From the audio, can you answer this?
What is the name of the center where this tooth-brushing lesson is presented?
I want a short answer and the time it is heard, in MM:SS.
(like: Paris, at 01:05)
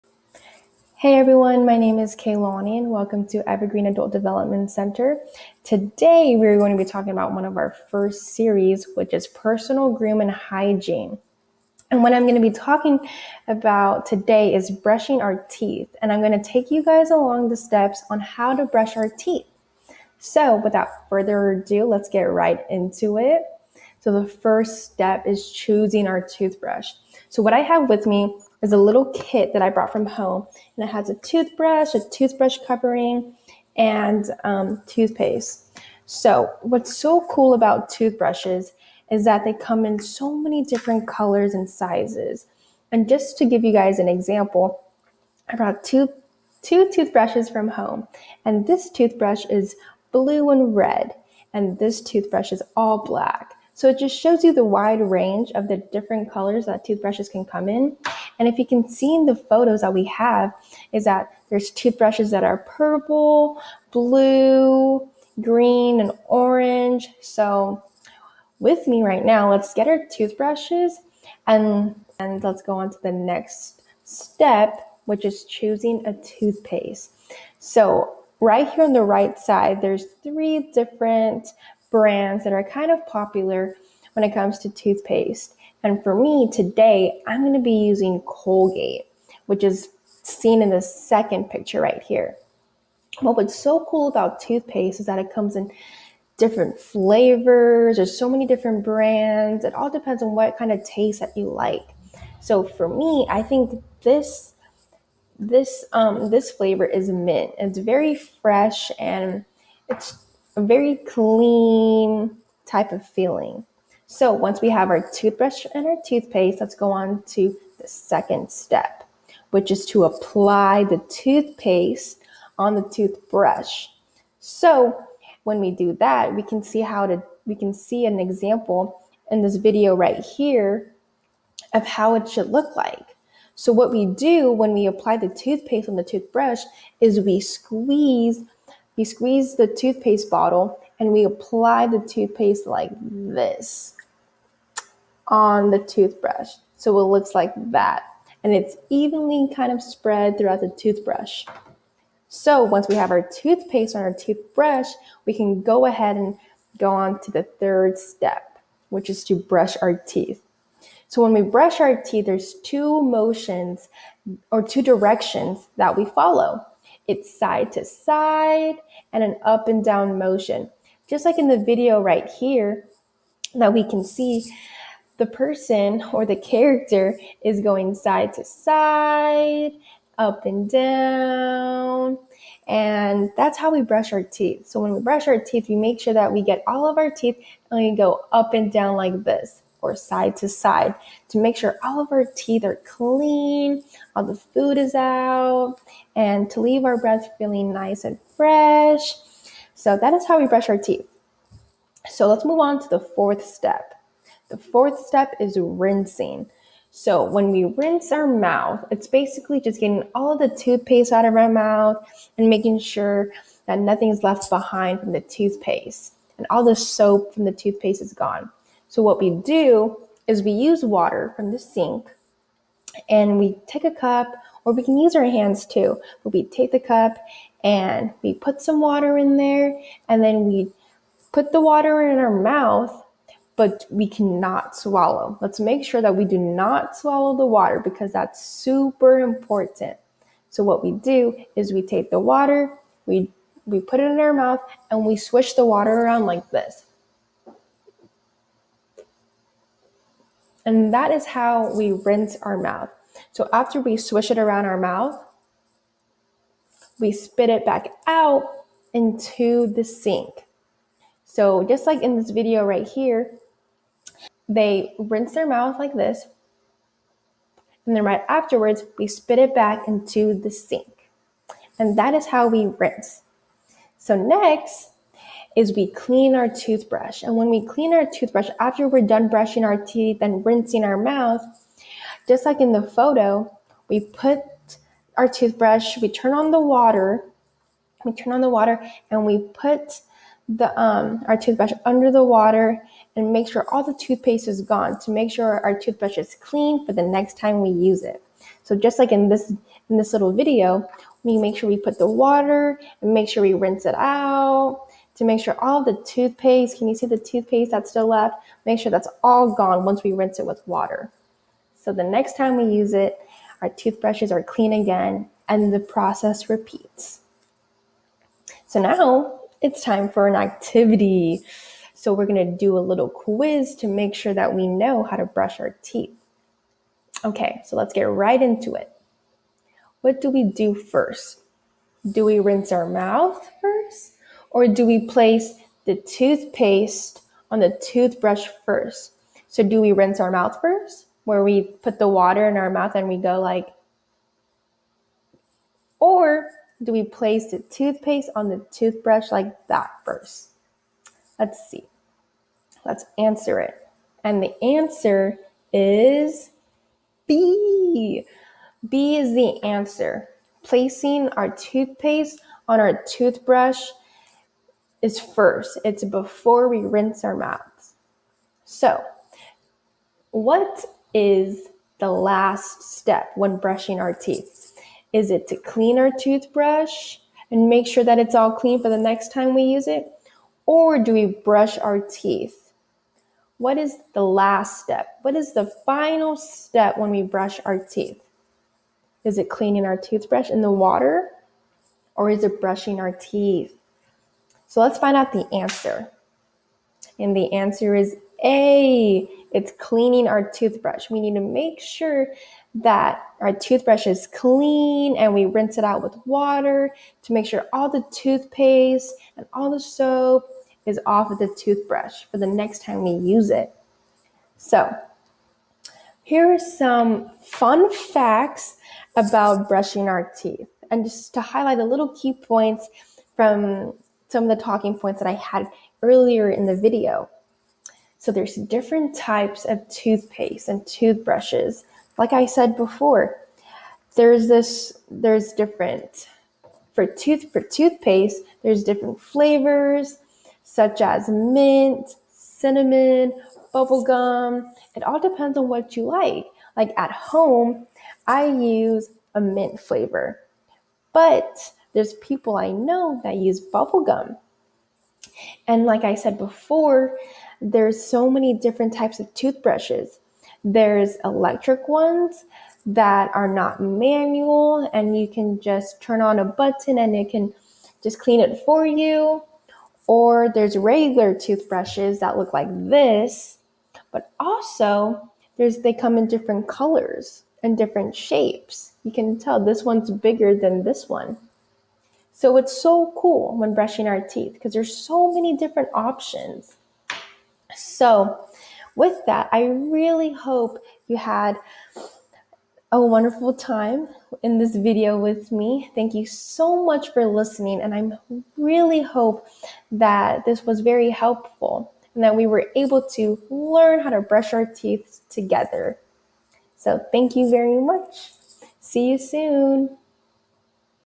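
Evergreen Adult Development Center, at 00:03.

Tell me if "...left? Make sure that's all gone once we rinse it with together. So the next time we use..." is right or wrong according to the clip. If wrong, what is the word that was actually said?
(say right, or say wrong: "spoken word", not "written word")
wrong: "water", not "together".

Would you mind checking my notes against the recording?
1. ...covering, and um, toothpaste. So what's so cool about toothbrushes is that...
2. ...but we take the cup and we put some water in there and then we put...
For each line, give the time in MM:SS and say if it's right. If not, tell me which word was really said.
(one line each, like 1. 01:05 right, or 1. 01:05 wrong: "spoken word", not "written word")
1. 00:32 right
2. 03:46 right.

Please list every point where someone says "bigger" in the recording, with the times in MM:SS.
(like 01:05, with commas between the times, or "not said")
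08:00.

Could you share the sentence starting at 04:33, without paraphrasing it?
So next, is we clean our toothbrush.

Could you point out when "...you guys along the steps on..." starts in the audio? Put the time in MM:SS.
00:16.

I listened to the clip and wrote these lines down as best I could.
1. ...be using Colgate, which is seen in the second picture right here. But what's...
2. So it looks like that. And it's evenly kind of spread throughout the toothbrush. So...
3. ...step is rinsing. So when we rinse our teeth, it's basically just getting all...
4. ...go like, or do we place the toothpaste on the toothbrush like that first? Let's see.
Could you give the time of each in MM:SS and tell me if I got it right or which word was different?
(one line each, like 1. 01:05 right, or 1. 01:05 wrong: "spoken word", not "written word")
1. 01:27 right
2. 02:26 right
3. 03:25 wrong: "mouth", not "teeth"
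4. 05:43 right.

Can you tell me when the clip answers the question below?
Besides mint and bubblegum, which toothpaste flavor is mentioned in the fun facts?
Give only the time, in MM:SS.
07:22.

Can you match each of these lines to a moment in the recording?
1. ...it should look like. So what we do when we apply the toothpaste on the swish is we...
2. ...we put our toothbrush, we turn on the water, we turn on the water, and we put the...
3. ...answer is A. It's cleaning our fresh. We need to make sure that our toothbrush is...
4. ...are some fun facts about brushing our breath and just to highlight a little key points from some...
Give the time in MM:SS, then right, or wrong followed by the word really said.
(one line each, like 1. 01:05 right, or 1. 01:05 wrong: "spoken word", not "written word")
1. 02:12 wrong: "toothbrush", not "swish"
2. 04:43 right
3. 06:37 wrong: "toothbrush", not "fresh"
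4. 06:56 wrong: "teeth", not "breath".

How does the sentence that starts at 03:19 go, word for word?
So that is how we brush our teeth.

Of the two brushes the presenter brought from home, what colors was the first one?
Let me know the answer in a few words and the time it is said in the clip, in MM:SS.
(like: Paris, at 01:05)
Blue and red, at 00:50.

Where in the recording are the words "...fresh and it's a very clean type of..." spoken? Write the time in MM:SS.
01:48.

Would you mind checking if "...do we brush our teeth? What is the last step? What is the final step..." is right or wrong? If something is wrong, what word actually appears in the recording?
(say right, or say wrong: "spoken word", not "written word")
right.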